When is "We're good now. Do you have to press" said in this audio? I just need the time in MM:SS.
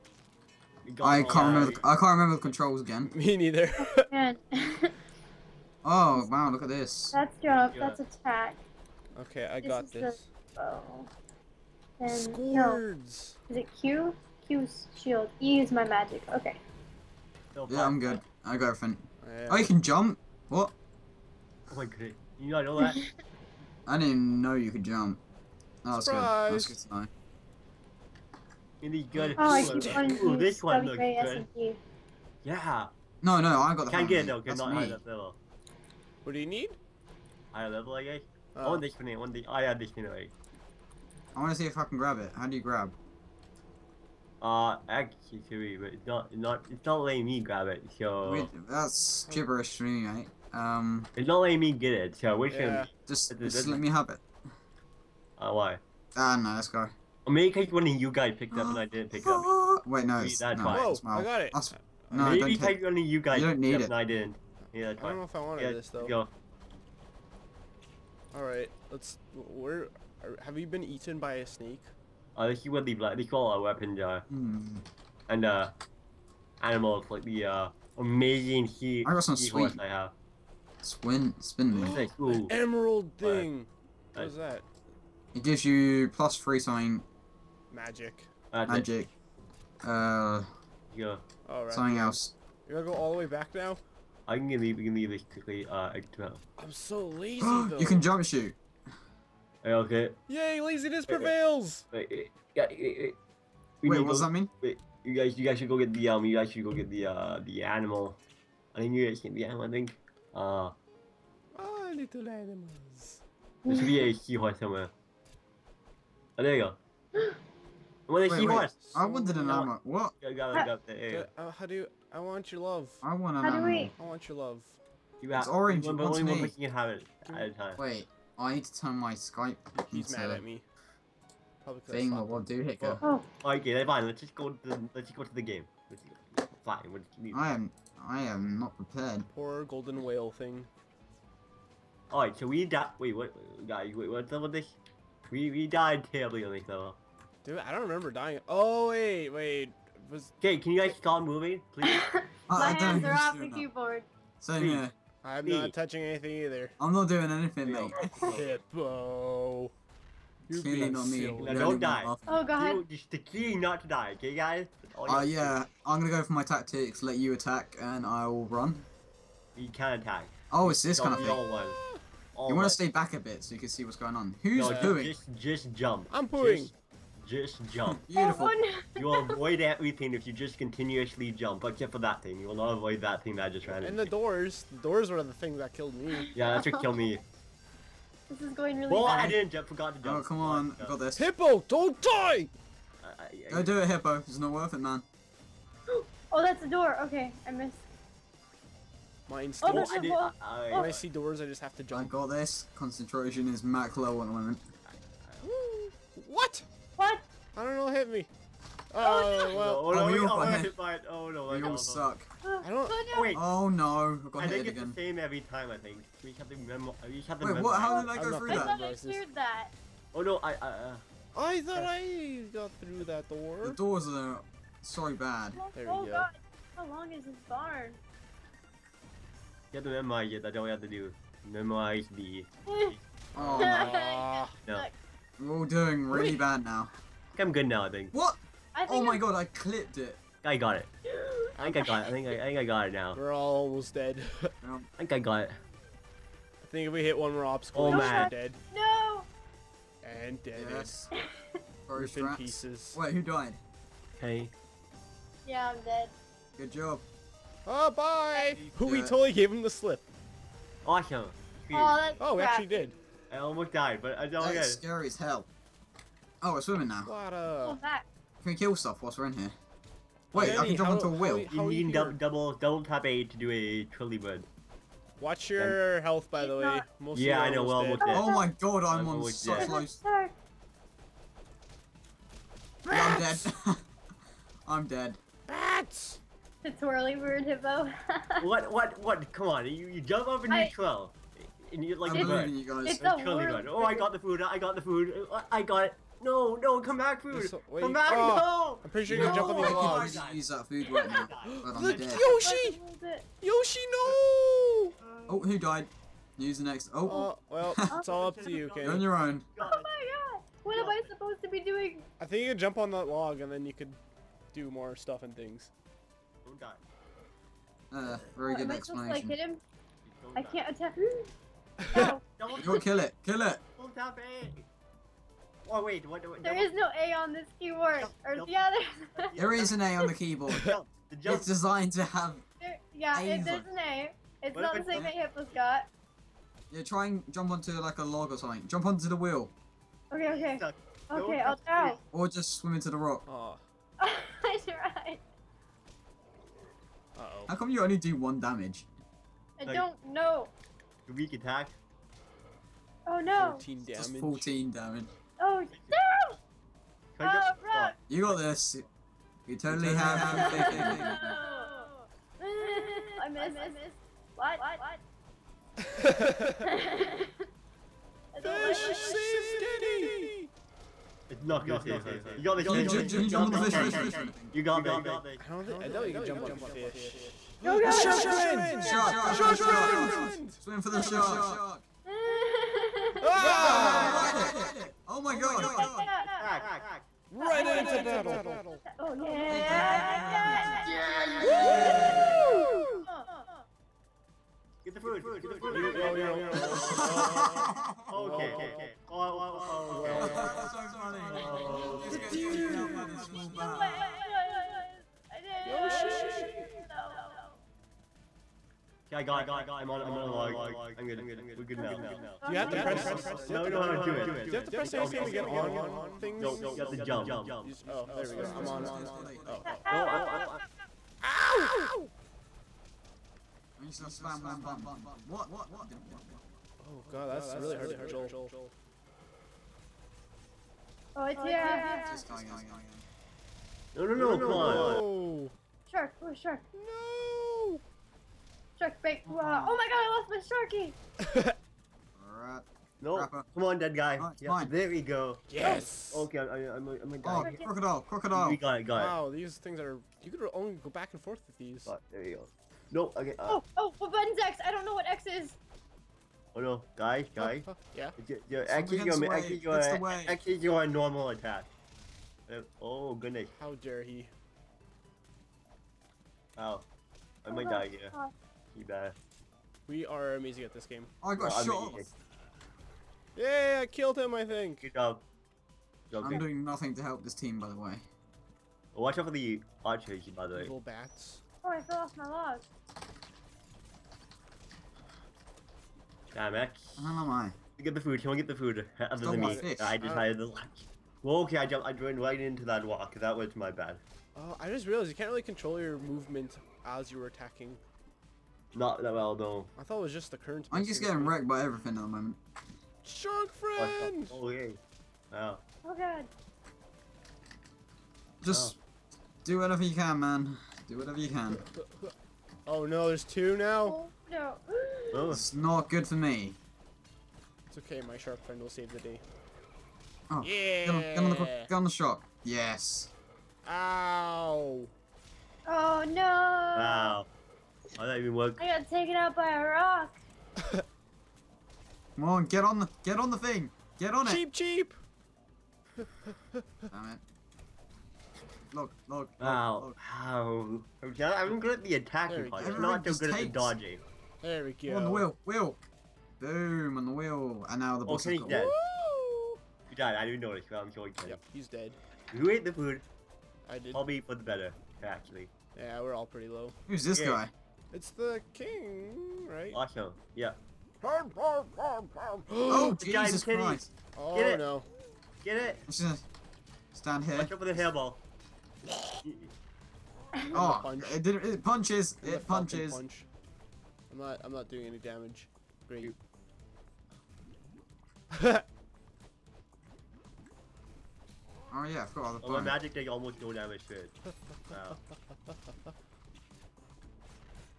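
06:51.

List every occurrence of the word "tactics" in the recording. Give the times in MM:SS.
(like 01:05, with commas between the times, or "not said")
02:46.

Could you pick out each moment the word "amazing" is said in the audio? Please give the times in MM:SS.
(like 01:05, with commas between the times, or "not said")
01:17, 07:50.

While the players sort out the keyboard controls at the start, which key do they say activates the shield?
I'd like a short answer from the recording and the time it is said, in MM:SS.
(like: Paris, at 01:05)
Q, at 00:14.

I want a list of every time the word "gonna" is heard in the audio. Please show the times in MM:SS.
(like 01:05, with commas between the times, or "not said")
02:46, 06:11, 07:04, 09:26.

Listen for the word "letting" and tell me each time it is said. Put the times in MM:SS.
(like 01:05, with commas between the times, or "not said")
00:47, 00:51.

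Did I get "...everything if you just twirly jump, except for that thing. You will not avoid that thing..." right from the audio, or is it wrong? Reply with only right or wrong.
wrong.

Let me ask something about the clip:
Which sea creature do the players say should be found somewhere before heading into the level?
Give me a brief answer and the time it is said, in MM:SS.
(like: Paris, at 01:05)
seahorse, at 01:54.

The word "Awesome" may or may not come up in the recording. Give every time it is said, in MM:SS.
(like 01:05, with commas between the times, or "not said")
04:20, 09:19.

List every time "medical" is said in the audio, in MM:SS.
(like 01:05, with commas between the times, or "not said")
not said.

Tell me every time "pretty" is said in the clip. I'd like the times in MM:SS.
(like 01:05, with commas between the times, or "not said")
04:58, 09:16.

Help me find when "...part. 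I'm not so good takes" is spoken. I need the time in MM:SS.
09:02.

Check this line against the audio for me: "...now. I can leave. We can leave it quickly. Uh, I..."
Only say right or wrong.
right.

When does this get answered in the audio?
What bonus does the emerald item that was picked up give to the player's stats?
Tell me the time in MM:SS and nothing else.
01:26.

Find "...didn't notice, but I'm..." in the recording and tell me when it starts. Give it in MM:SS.
09:10.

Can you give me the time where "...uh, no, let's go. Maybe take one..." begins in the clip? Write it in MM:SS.
00:56.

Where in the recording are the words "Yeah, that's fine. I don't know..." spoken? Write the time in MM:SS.
01:04.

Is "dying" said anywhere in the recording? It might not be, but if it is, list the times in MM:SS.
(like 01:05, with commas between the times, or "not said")
02:28.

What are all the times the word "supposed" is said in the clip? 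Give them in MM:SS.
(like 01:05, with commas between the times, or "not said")
05:11, 05:19.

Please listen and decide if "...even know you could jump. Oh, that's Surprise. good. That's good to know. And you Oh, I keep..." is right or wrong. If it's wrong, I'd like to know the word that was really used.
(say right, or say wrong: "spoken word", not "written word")
right.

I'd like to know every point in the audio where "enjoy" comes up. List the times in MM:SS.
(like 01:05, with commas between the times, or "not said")
not said.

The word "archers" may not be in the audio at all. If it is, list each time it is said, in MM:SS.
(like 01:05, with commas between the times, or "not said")
07:59.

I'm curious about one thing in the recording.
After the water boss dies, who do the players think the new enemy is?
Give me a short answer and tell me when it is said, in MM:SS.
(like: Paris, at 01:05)
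the king, at 09:18.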